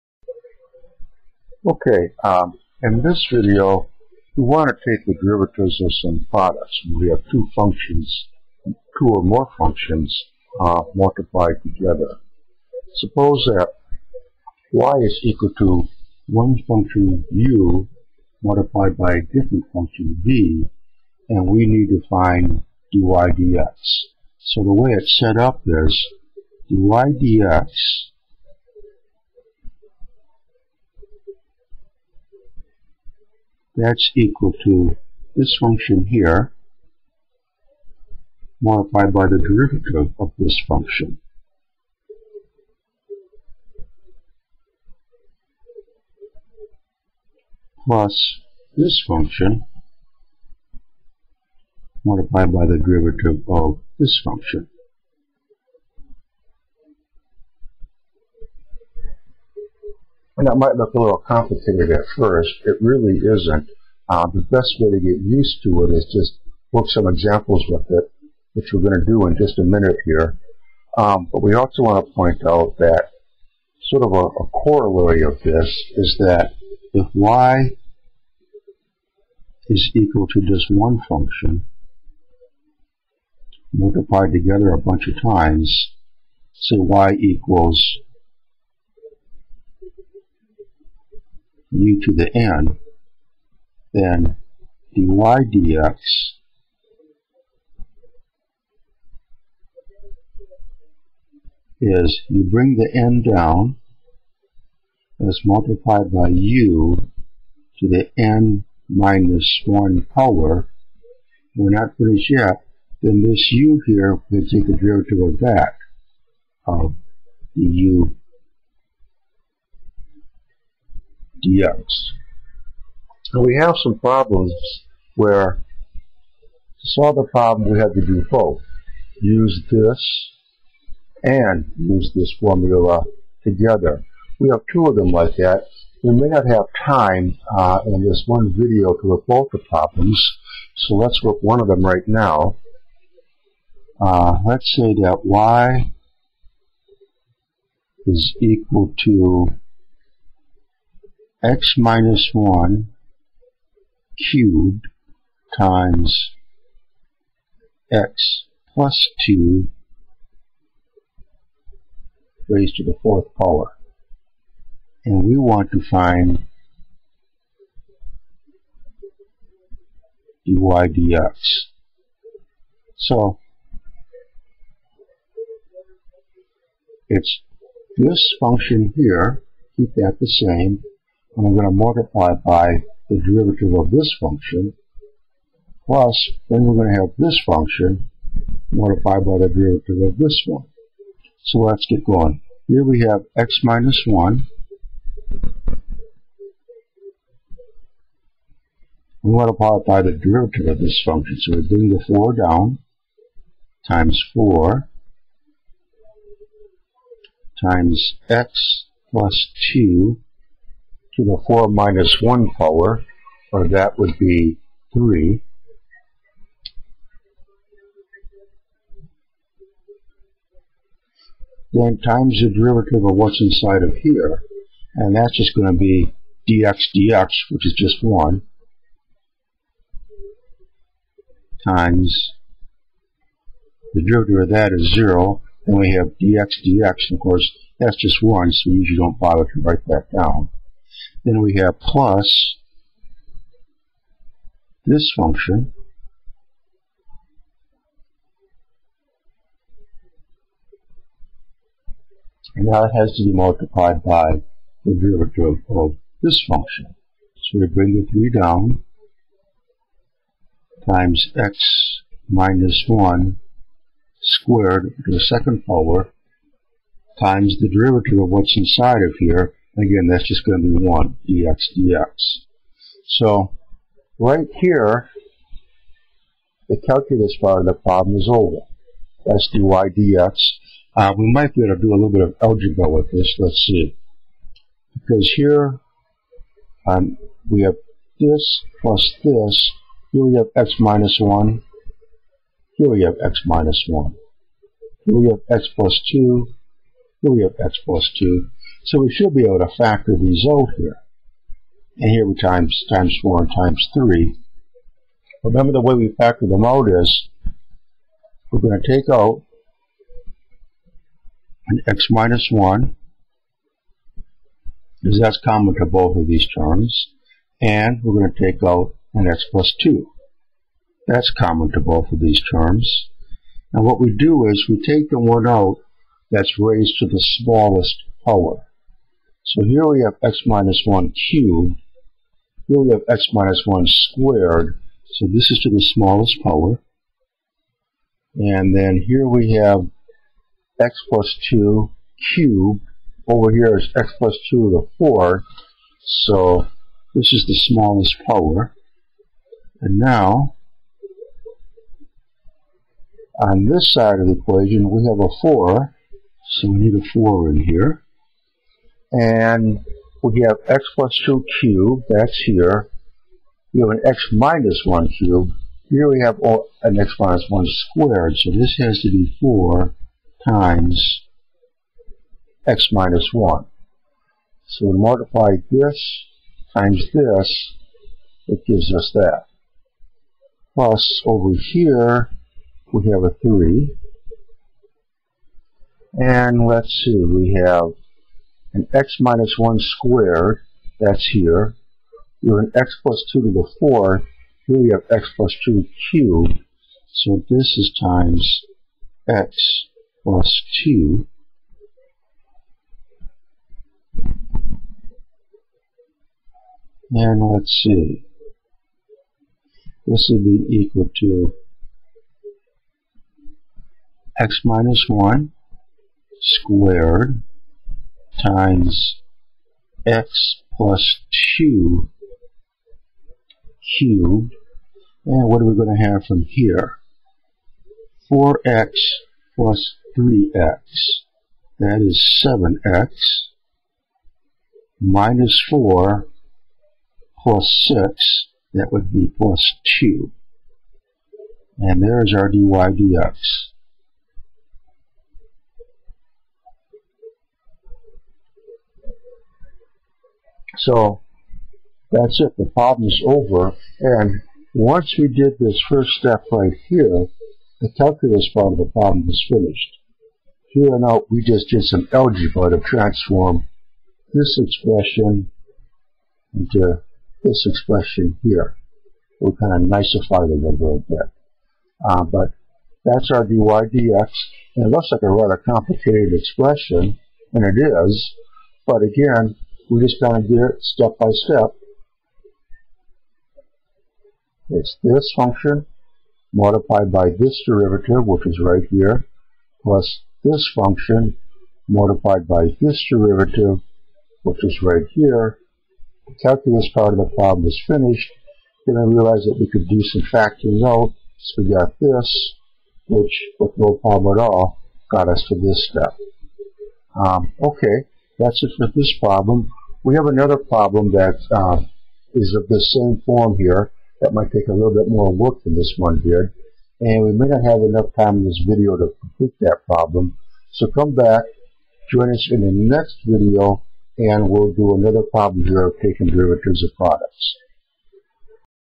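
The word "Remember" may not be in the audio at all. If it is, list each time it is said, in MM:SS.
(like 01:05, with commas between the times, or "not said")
05:05.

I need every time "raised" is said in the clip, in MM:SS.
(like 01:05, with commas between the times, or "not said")
02:42, 05:26.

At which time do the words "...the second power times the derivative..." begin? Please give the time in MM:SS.
04:25.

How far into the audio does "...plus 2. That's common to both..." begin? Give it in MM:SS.
05:19.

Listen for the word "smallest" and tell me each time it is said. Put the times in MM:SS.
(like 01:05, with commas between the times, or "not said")
05:27, 05:35, 05:47.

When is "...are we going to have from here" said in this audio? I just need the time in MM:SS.
07:05.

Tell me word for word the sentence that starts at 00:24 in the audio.
So the way it's set up is dy dx that's equal to this function here multiplied by the derivative of this function.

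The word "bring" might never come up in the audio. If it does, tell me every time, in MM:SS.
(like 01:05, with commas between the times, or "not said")
01:42, 03:21, 04:17.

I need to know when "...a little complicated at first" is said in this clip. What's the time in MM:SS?
01:00.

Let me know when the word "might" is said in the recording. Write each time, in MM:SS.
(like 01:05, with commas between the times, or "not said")
01:00, 04:41, 08:34.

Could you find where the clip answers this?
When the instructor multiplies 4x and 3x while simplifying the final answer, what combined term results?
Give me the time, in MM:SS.
07:12.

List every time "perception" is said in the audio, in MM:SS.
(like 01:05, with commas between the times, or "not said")
not said.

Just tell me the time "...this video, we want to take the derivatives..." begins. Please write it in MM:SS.
00:03.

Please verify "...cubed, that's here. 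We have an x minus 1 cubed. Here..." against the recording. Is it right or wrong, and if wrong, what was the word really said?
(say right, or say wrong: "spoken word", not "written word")
right.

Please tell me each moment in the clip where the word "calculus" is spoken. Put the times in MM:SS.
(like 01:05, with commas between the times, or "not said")
04:36, 07:37, 08:16.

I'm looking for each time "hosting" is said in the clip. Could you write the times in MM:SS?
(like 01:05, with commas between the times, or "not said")
not said.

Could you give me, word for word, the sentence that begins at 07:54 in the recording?
And it looks like a rather complicated expression, and it is.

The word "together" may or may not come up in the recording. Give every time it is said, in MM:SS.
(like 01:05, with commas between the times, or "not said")
00:11, 01:24, 02:13.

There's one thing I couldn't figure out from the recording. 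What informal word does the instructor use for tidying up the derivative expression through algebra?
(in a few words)
nicify.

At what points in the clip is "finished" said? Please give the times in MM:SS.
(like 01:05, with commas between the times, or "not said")
01:51, 07:39, 08:17.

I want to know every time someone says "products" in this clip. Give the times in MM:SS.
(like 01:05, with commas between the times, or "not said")
00:06, 08:46.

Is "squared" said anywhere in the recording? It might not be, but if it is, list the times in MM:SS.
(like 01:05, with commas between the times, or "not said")
04:24, 05:33, 06:07, 06:29, 06:56.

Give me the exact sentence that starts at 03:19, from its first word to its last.
We multiply it by the derivative of this function.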